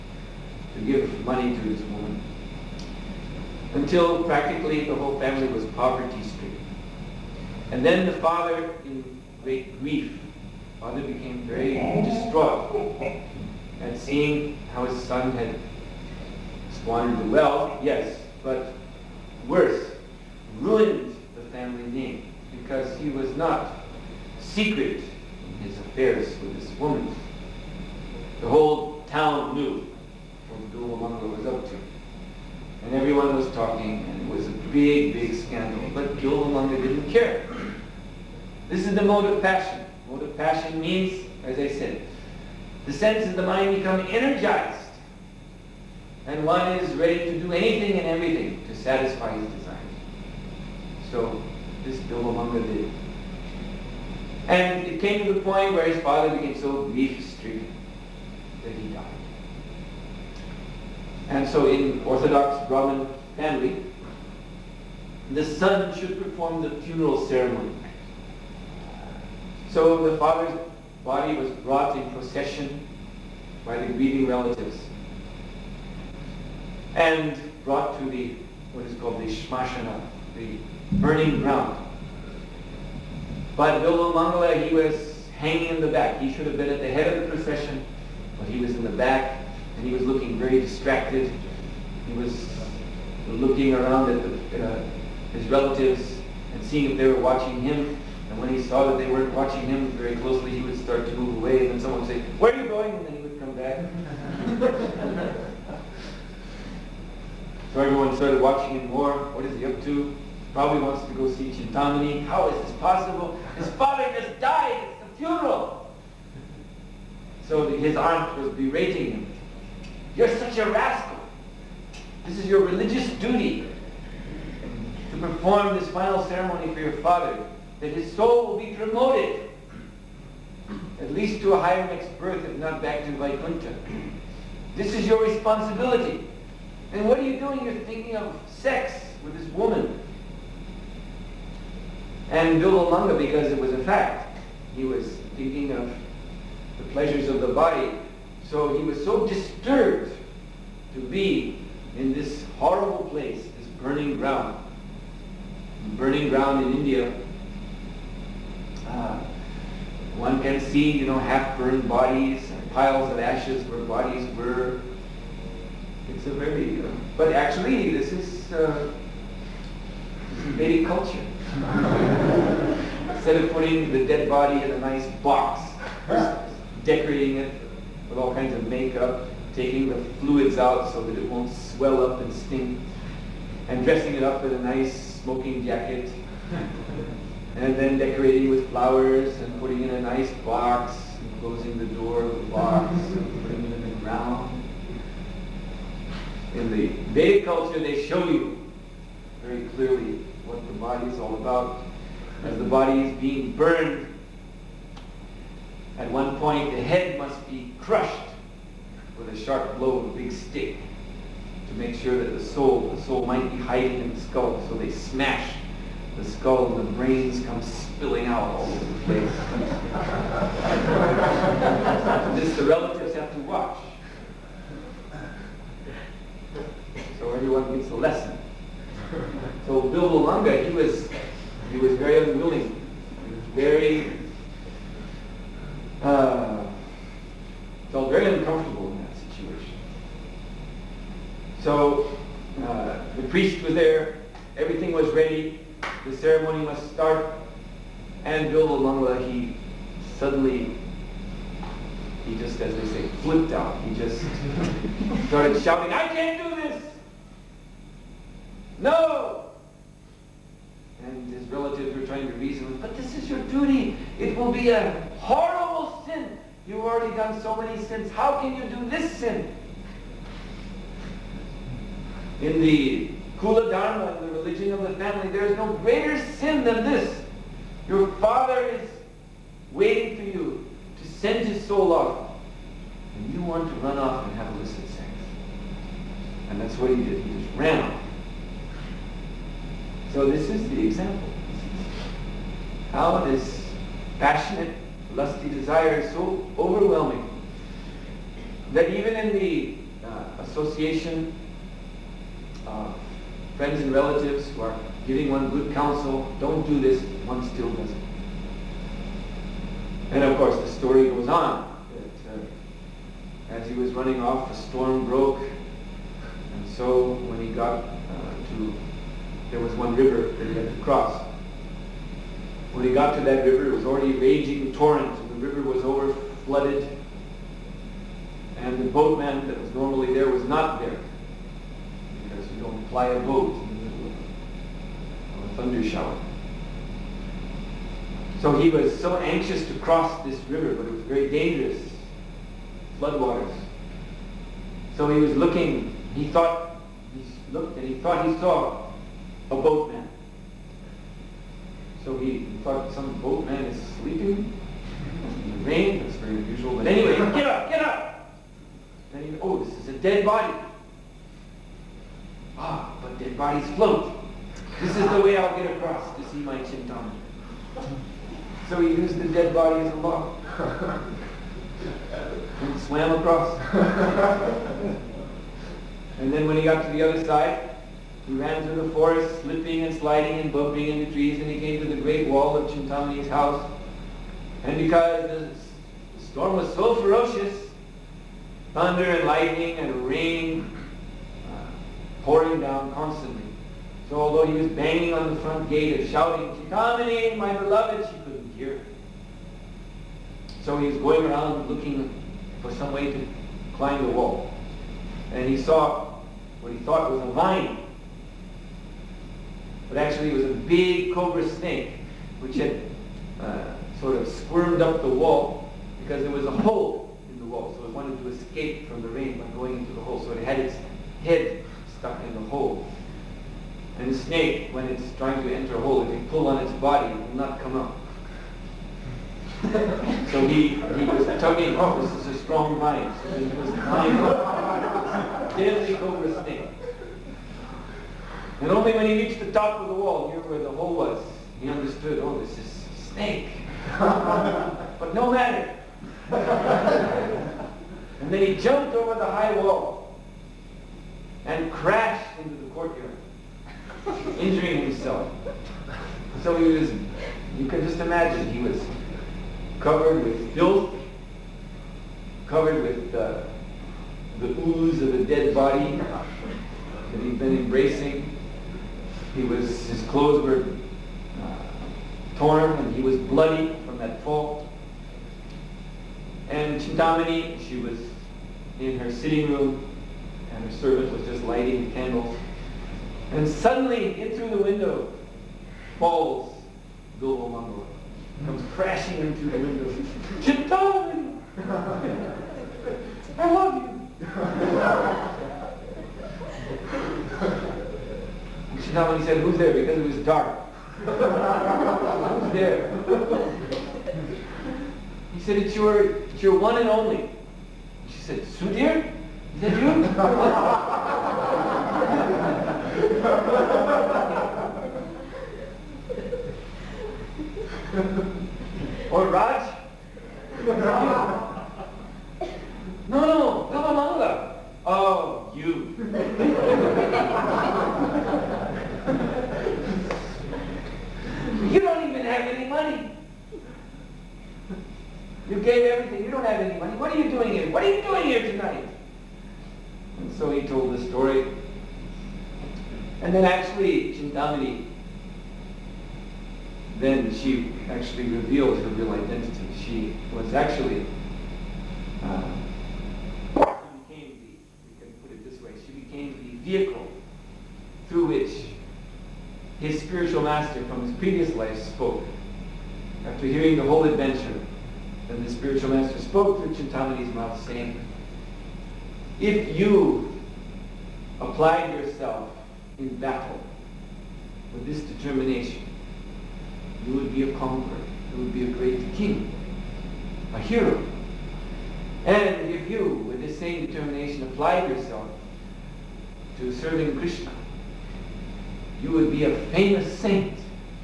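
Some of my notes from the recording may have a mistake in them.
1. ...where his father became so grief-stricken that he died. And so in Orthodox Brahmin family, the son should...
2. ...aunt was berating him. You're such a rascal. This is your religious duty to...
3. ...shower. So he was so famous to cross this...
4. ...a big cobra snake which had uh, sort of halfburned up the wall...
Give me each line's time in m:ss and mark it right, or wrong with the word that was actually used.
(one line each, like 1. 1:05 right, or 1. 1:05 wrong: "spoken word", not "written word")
1. 0:55 right
2. 1:57 right
3. 5:35 wrong: "anxious", not "famous"
4. 6:50 wrong: "squirmed", not "halfburned".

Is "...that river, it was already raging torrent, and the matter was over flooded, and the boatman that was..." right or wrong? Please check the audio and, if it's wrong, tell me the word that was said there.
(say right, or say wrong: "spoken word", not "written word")
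wrong: "river", not "matter".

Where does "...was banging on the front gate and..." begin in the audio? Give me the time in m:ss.
6:34.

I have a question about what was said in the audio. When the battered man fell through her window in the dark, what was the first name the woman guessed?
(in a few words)
Sudhir.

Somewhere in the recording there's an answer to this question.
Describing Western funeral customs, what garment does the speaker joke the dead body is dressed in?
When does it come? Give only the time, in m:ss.
3:05.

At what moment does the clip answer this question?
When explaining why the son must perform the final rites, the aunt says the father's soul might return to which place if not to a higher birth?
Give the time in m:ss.
2:13.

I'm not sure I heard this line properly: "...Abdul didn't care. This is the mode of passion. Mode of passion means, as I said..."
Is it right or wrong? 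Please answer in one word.
right.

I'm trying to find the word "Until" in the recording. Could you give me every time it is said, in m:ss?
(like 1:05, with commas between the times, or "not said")
0:03.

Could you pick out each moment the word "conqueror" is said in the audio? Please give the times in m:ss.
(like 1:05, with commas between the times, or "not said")
9:37.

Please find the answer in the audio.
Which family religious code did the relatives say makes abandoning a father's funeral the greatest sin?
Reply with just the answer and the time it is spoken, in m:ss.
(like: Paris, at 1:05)
Kula Dharma, at 4:33.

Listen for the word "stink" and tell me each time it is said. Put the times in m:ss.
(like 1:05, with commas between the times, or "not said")
3:02.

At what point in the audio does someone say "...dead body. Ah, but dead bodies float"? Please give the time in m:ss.
5:59.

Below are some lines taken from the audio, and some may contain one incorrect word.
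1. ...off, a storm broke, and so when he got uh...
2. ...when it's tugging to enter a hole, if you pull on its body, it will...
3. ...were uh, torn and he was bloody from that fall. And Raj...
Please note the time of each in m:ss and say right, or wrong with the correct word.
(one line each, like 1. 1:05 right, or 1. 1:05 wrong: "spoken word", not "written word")
1. 5:14 right
2. 7:04 wrong: "trying", not "tugging"
3. 7:50 wrong: "Chintamani", not "Raj".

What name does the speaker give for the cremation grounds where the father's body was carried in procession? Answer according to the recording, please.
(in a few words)
shmashana.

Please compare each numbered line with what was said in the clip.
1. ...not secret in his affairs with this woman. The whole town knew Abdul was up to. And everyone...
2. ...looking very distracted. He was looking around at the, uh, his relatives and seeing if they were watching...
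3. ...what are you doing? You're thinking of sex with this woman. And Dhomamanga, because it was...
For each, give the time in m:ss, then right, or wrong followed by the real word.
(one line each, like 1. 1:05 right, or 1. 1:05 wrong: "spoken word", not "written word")
1. 0:23 right
2. 1:30 right
3. 2:17 wrong: "Bilvamangala", not "Dhomamanga".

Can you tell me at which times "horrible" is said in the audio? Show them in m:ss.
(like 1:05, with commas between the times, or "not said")
2:32, 4:25.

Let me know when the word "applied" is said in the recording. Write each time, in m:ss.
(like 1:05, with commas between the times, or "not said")
9:31, 9:44.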